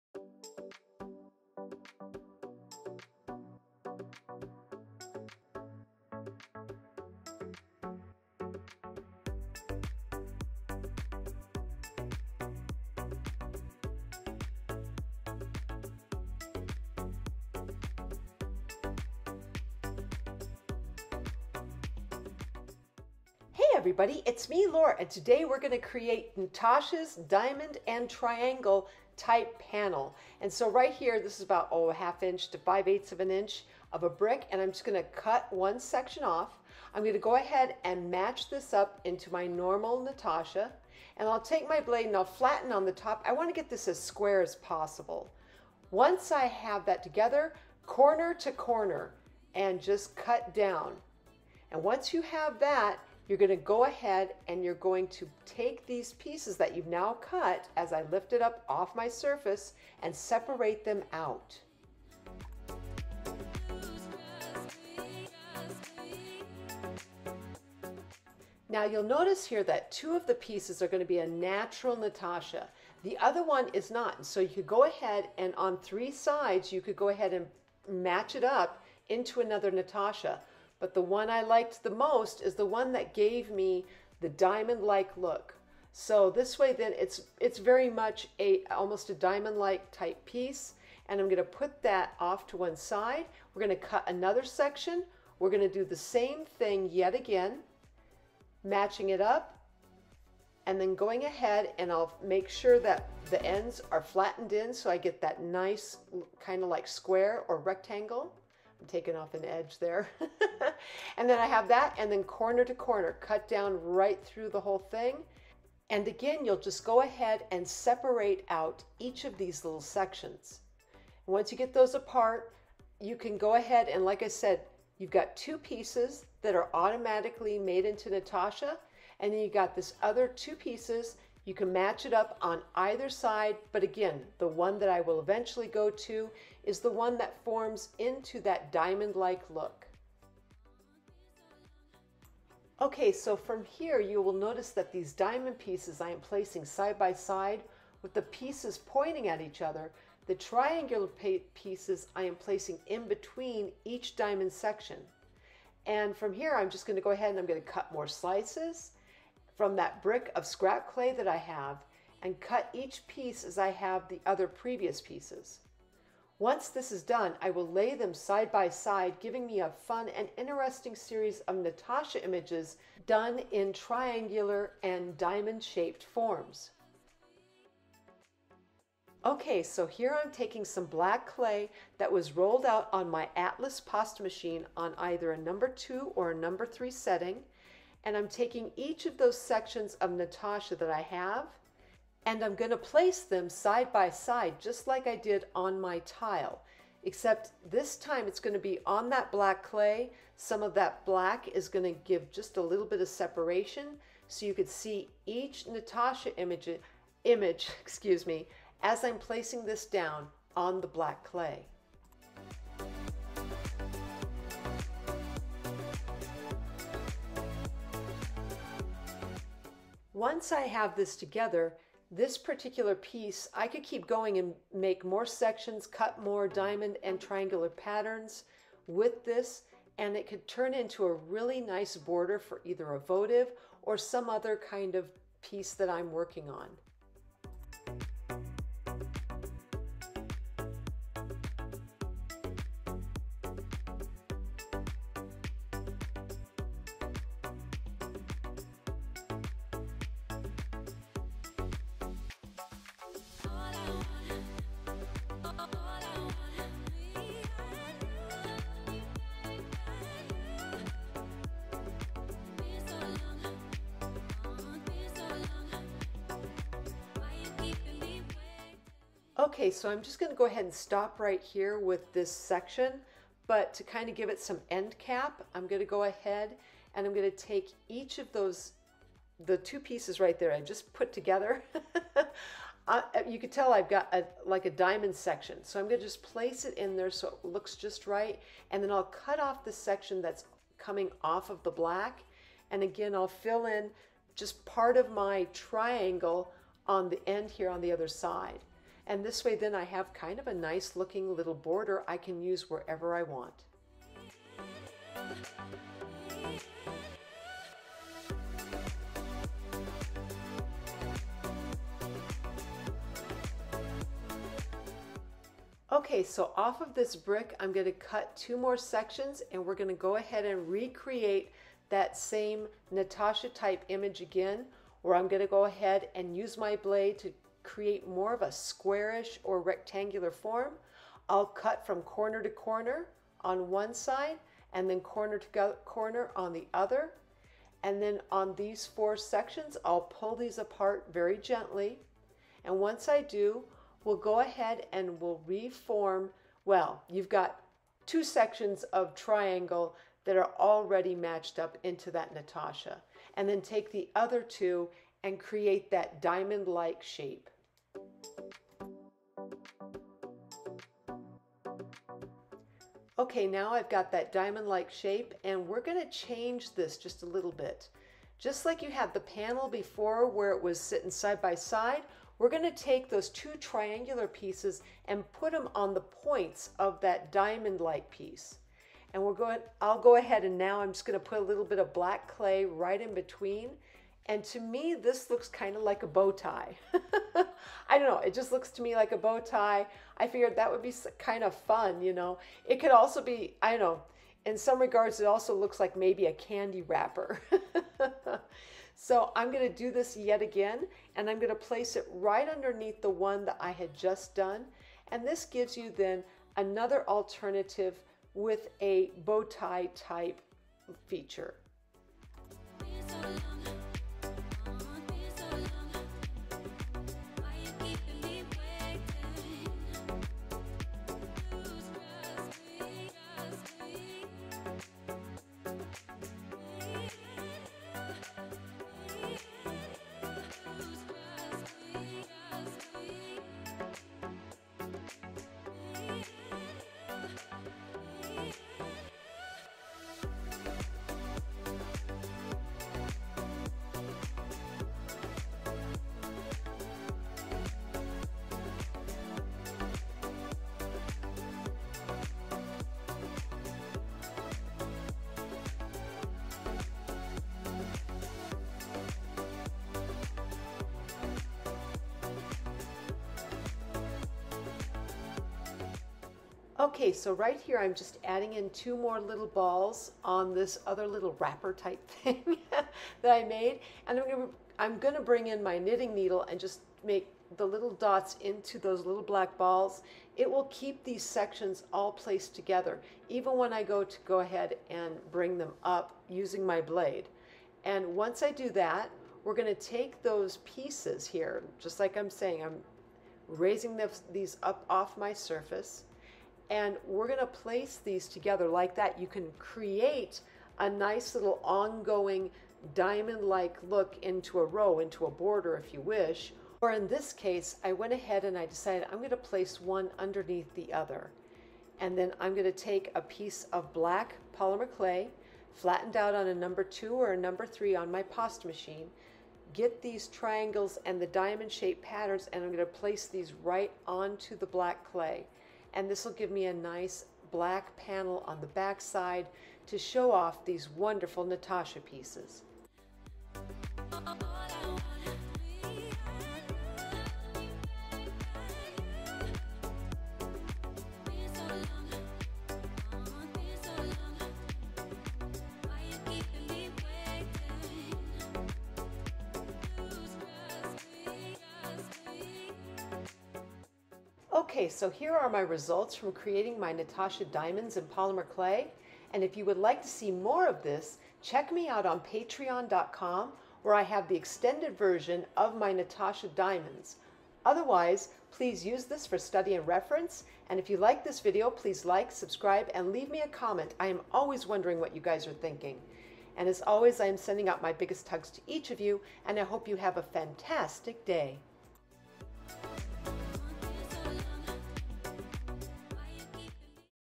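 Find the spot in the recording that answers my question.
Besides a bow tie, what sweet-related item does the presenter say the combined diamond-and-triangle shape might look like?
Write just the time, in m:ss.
6:36.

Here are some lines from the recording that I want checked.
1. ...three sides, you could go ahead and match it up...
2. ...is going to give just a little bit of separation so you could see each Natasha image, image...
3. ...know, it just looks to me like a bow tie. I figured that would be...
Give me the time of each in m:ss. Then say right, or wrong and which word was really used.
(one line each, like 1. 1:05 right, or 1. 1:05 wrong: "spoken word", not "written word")
1. 1:15 right
2. 3:21 right
3. 6:28 right.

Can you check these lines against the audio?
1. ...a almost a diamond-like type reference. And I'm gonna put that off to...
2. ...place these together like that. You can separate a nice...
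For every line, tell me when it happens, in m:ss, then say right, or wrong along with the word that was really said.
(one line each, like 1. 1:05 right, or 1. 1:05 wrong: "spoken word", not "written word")
1. 1:28 wrong: "piece", not "reference"
2. 8:17 wrong: "create", not "separate".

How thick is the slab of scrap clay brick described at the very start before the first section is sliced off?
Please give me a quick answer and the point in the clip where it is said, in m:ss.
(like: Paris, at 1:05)
half inch to five eighths of an inch, at 0:31.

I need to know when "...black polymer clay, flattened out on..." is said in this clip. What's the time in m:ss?
8:33.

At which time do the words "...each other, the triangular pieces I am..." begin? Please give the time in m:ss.
2:29.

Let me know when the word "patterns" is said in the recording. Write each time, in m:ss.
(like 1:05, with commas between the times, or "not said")
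3:47, 8:42.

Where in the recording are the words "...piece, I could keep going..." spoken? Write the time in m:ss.
3:42.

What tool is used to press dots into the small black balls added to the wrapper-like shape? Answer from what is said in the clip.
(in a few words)
knitting needle.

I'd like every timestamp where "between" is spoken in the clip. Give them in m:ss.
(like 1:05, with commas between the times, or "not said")
2:33, 6:23.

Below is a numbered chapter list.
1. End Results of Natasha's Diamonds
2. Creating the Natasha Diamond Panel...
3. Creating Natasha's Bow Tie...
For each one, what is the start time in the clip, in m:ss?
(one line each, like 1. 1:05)
1. 9:14
2. 0:19
3. 5:12.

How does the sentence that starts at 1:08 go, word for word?
Now you'll notice here that two of the pieces are going to be a natural Natasha.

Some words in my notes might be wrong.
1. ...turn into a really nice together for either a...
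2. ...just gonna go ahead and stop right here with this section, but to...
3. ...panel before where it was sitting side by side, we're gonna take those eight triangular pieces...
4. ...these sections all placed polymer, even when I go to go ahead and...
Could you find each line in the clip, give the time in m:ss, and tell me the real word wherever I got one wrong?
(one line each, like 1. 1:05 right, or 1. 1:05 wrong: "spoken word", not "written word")
1. 3:50 wrong: "border", not "together"
2. 4:30 right
3. 6:09 wrong: "two", not "eight"
4. 8:01 wrong: "together", not "polymer".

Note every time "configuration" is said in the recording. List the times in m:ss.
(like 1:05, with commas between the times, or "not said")
not said.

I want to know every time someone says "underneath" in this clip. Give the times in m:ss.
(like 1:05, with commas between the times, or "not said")
6:42, 8:30.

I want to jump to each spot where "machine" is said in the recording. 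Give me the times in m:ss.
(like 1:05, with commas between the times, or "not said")
3:04, 8:38.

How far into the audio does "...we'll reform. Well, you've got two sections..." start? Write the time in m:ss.
5:45.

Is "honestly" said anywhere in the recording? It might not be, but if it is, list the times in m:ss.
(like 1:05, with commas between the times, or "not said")
not said.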